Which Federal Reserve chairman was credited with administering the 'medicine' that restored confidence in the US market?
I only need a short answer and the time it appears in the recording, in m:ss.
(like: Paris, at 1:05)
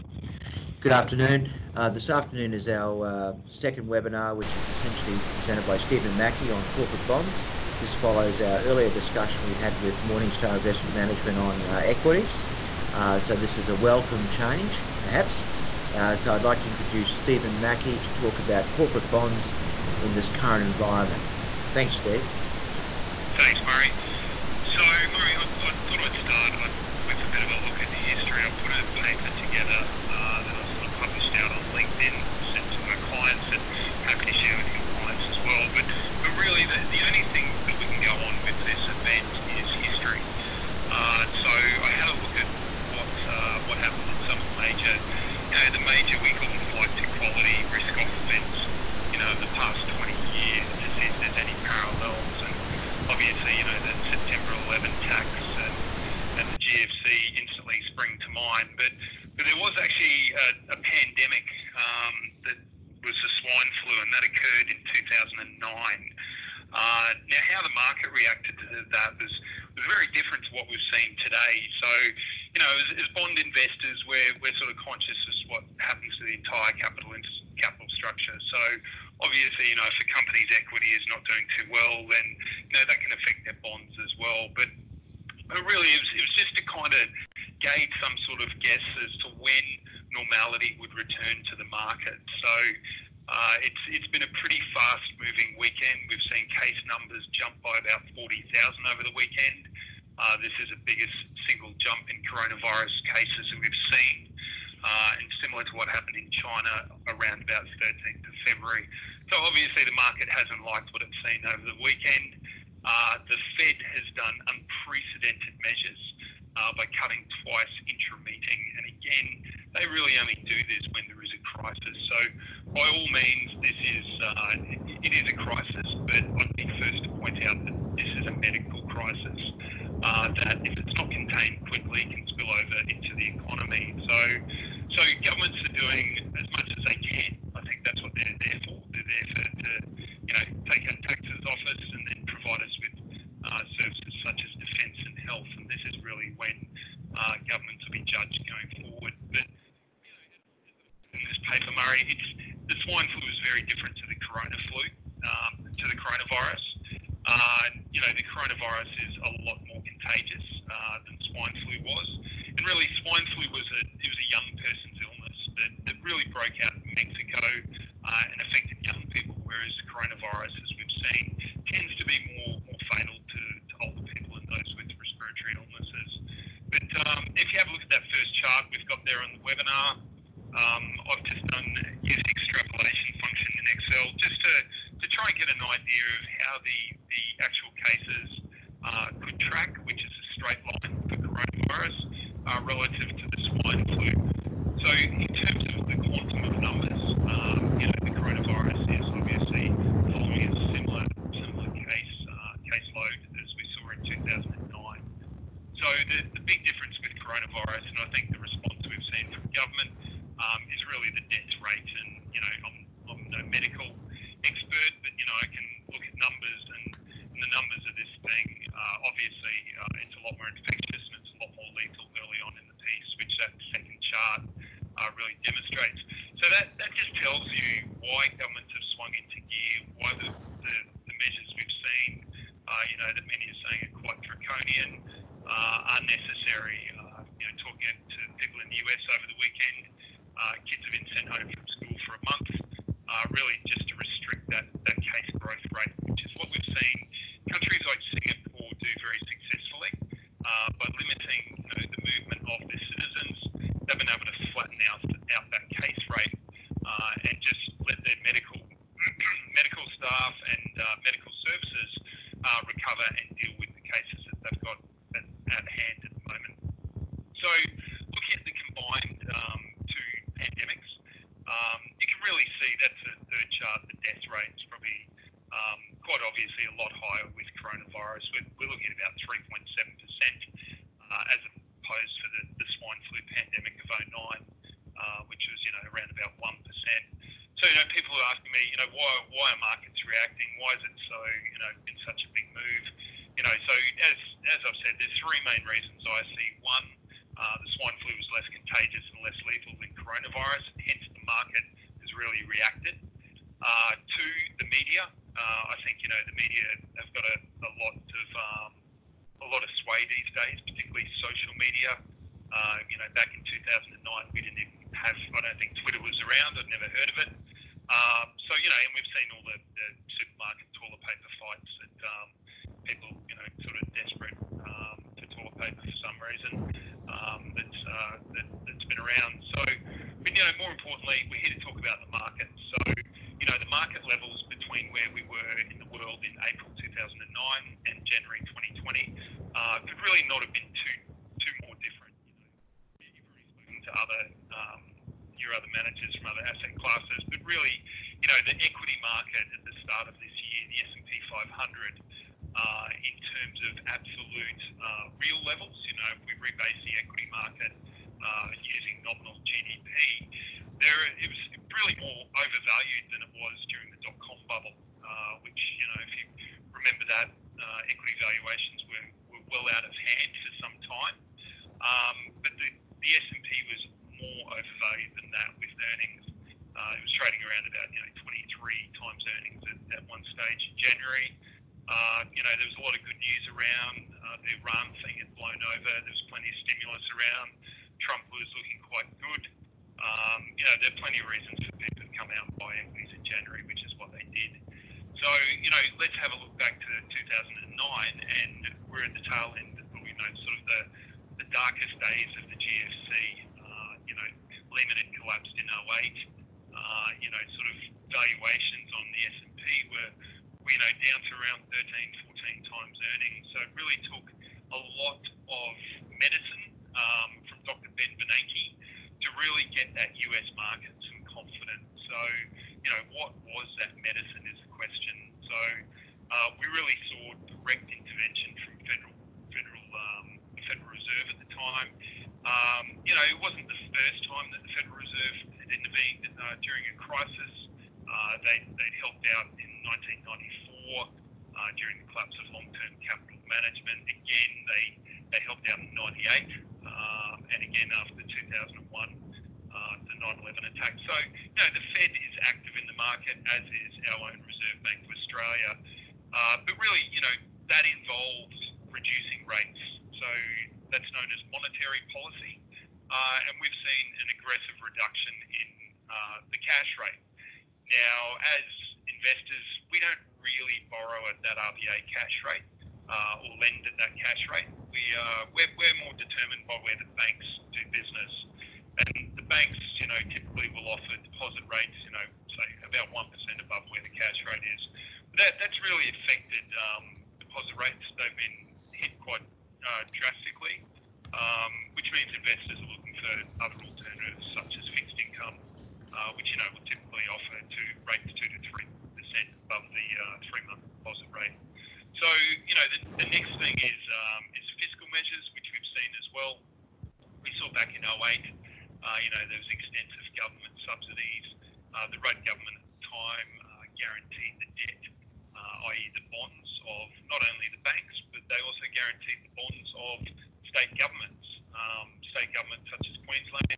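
Ben Bernanke, at 6:57.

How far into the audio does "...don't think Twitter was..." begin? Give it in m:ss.
5:15.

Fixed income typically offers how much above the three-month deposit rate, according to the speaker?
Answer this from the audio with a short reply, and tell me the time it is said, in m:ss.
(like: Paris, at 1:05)
2 to 3%, at 8:18.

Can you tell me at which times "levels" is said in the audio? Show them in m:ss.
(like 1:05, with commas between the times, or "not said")
5:34, 5:55.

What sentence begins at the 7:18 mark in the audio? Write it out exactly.
Uh, they they'd helped out in 1994 uh, during the collapse of long-term capital management.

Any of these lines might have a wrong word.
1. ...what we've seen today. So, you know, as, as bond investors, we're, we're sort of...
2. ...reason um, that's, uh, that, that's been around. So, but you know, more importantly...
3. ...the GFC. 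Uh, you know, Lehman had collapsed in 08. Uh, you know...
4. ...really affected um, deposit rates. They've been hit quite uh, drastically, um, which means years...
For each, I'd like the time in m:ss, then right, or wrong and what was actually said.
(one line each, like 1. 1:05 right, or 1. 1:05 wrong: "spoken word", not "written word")
1. 1:10 right
2. 5:26 right
3. 6:42 right
4. 8:05 wrong: "investors", not "years".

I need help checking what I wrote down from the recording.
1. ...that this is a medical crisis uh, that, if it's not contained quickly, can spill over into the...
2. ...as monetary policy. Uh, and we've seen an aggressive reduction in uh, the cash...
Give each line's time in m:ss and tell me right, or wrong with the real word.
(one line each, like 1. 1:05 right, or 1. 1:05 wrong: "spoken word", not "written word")
1. 2:07 right
2. 7:41 right.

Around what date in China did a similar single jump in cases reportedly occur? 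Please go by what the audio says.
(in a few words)
13th of February.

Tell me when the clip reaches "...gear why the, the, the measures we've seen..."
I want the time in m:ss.
3:49.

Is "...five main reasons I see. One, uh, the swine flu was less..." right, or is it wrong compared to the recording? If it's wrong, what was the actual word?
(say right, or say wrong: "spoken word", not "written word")
wrong: "three", not "five".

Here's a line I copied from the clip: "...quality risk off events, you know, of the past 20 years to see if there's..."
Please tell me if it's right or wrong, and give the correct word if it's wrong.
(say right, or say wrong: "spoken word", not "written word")
right.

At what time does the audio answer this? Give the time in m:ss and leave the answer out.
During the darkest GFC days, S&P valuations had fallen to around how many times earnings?
6:51.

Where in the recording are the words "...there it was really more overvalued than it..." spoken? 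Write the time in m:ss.
6:00.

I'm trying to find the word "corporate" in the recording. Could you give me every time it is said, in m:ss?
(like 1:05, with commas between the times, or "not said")
0:06, 0:18.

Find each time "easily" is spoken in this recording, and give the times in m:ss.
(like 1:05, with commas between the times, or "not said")
not said.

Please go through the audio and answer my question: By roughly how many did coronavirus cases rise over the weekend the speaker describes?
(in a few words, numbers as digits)
40,000.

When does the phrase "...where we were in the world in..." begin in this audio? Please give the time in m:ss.
5:34.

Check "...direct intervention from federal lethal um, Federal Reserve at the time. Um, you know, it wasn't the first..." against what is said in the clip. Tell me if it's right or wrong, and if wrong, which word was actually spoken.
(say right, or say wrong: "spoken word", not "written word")
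wrong: "federal", not "lethal".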